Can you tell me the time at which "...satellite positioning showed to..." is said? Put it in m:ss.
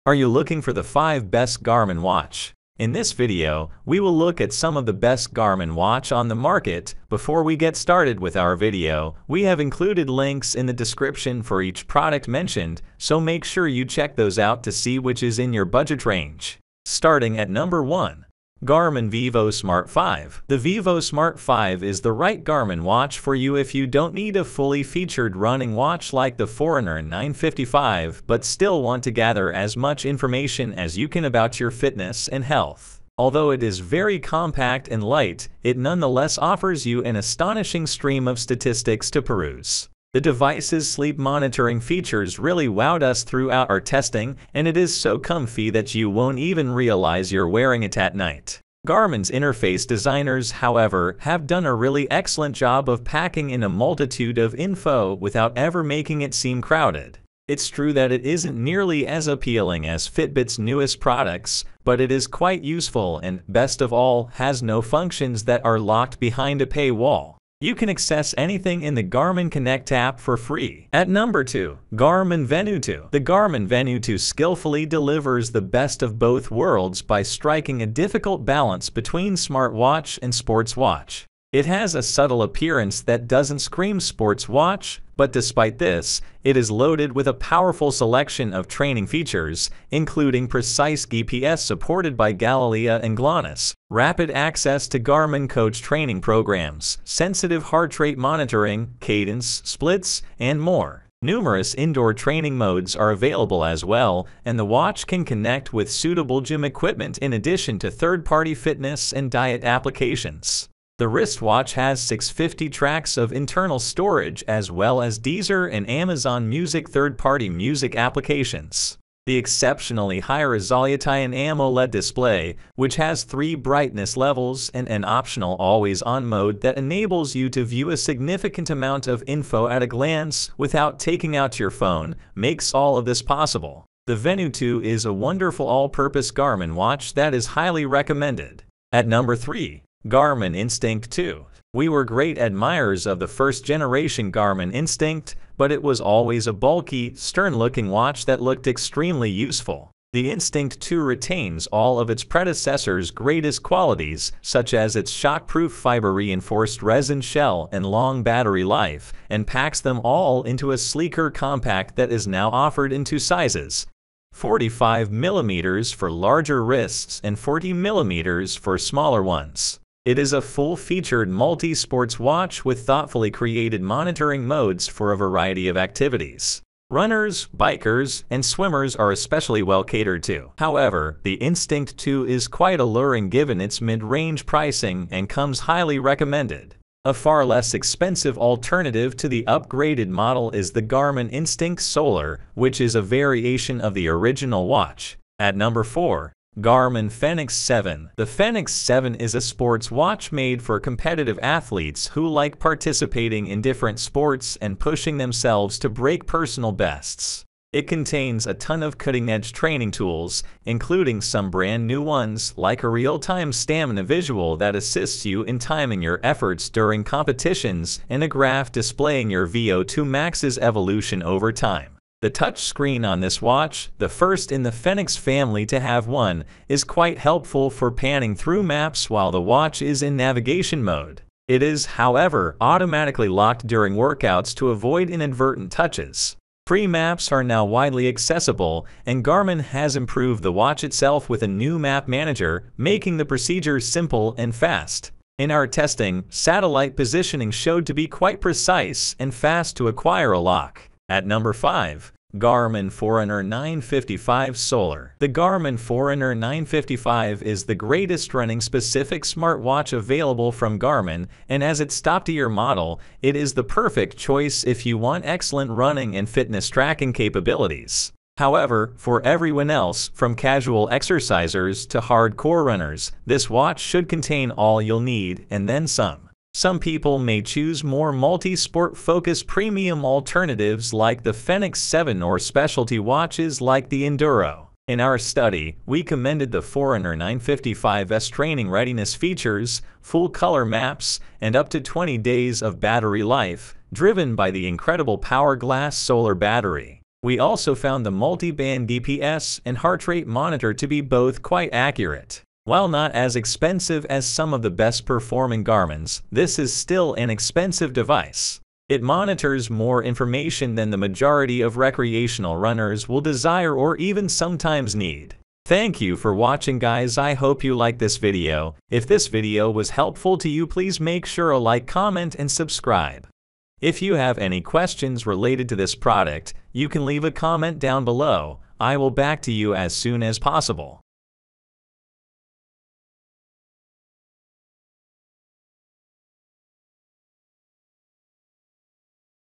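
4:06.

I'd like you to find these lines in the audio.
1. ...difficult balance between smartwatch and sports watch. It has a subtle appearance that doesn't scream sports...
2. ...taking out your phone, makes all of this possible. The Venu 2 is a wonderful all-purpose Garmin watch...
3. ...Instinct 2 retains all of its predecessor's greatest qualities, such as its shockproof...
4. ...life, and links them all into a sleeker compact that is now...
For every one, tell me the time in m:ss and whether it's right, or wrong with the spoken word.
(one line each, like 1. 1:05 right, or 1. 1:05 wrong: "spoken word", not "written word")
1. 1:17 right
2. 2:10 right
3. 2:30 right
4. 2:38 wrong: "packs", not "links".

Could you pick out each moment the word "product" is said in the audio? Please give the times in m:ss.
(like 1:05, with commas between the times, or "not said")
0:11, 1:00, 5:25.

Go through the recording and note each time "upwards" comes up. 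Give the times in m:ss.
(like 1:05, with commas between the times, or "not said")
not said.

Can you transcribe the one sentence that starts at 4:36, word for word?
Some people may choose more multi-sport focused premium alternatives like the Fenix 7 or specialty watches like the Enduro.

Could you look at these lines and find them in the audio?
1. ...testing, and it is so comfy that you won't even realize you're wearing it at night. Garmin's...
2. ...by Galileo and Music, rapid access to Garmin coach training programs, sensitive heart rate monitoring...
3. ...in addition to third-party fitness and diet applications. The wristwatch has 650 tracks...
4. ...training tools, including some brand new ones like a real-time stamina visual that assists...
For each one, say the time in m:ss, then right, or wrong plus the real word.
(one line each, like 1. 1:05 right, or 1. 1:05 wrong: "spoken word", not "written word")
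1. 0:43 right
2. 1:32 wrong: "GLONASS", not "Music"
3. 1:47 right
4. 3:29 right.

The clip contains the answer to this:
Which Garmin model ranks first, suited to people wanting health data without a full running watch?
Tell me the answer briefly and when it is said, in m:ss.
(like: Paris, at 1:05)
Garmin Vivosmart 5, at 0:18.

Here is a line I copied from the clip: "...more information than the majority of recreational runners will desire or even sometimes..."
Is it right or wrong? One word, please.
right.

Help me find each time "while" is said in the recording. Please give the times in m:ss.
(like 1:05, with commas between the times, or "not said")
3:49, 5:02.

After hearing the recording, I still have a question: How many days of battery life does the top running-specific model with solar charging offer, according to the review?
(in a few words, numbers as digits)
20.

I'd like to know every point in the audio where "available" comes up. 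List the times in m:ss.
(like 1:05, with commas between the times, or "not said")
1:43, 4:19.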